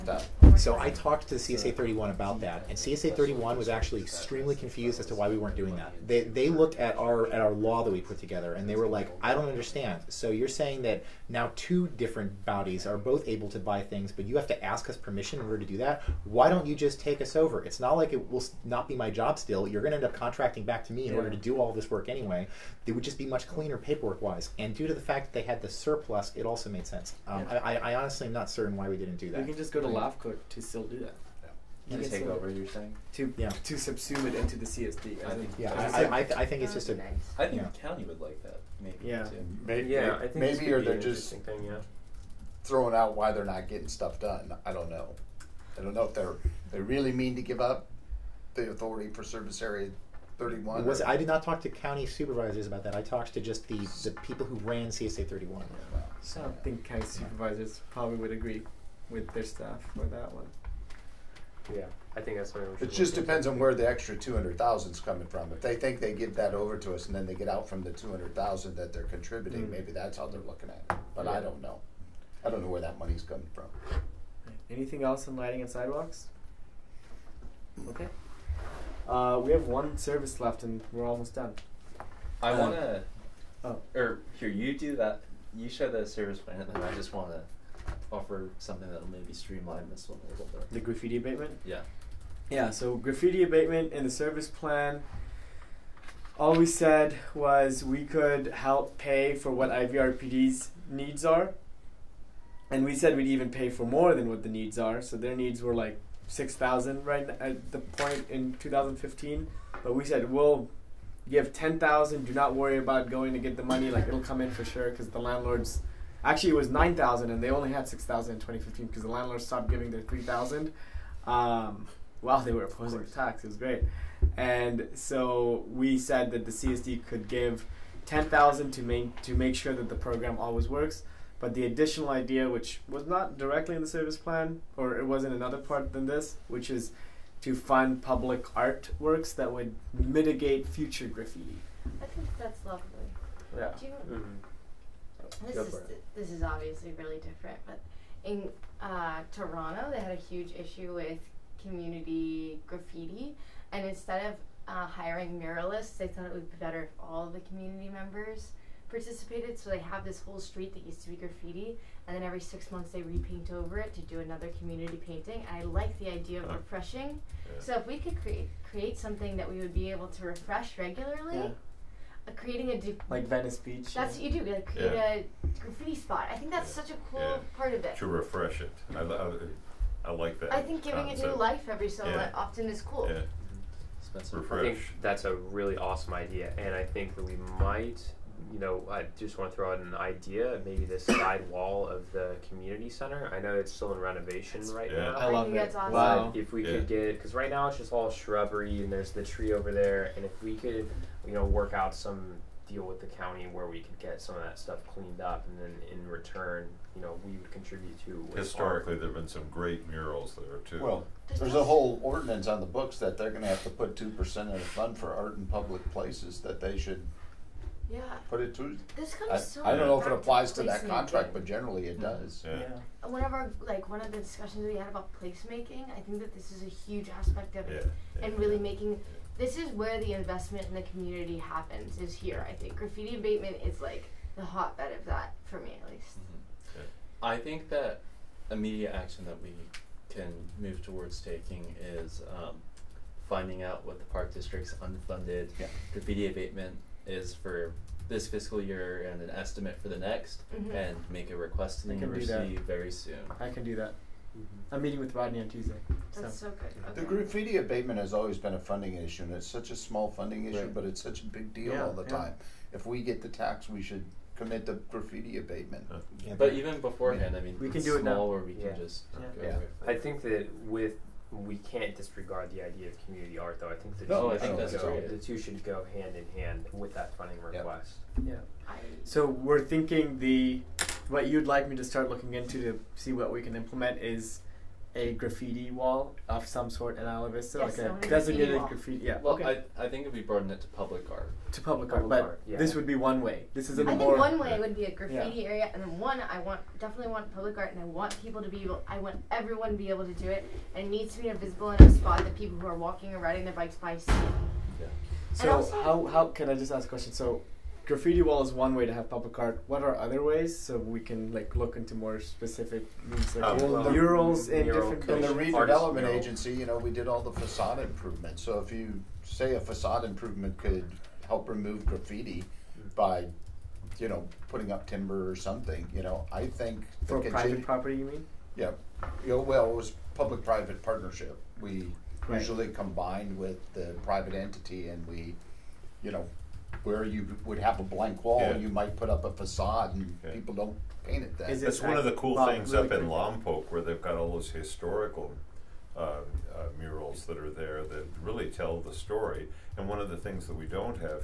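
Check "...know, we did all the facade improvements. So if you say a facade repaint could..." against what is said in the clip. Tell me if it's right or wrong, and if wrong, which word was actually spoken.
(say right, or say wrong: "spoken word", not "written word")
wrong: "improvement", not "repaint".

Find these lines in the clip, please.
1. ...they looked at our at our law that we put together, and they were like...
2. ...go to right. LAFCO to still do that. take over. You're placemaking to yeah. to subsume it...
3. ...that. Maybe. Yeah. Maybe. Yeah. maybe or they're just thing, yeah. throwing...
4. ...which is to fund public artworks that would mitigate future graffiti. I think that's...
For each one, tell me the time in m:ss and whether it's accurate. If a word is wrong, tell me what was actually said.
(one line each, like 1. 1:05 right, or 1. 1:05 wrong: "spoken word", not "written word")
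1. 0:06 right
2. 0:29 wrong: "saying", not "placemaking"
3. 0:38 right
4. 2:16 right.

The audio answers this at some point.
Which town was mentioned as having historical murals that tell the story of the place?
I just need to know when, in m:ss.
5:43.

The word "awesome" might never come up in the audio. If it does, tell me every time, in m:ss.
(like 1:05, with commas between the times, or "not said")
3:05, 3:15.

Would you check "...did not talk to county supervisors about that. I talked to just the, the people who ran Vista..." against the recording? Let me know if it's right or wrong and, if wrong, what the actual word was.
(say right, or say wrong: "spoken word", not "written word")
wrong: "CSA", not "Vista".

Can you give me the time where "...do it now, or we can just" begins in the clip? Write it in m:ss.
4:27.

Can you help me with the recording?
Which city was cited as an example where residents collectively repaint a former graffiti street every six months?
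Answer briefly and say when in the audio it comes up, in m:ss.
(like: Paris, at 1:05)
Toronto, at 2:29.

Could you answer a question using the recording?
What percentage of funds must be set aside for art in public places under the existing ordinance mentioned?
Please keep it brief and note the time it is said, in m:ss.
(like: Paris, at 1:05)
2%, at 3:33.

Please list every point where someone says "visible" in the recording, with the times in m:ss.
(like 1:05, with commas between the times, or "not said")
5:01.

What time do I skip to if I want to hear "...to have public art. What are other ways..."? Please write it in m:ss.
5:08.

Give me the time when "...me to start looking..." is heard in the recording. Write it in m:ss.
4:41.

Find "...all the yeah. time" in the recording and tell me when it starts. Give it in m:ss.
4:21.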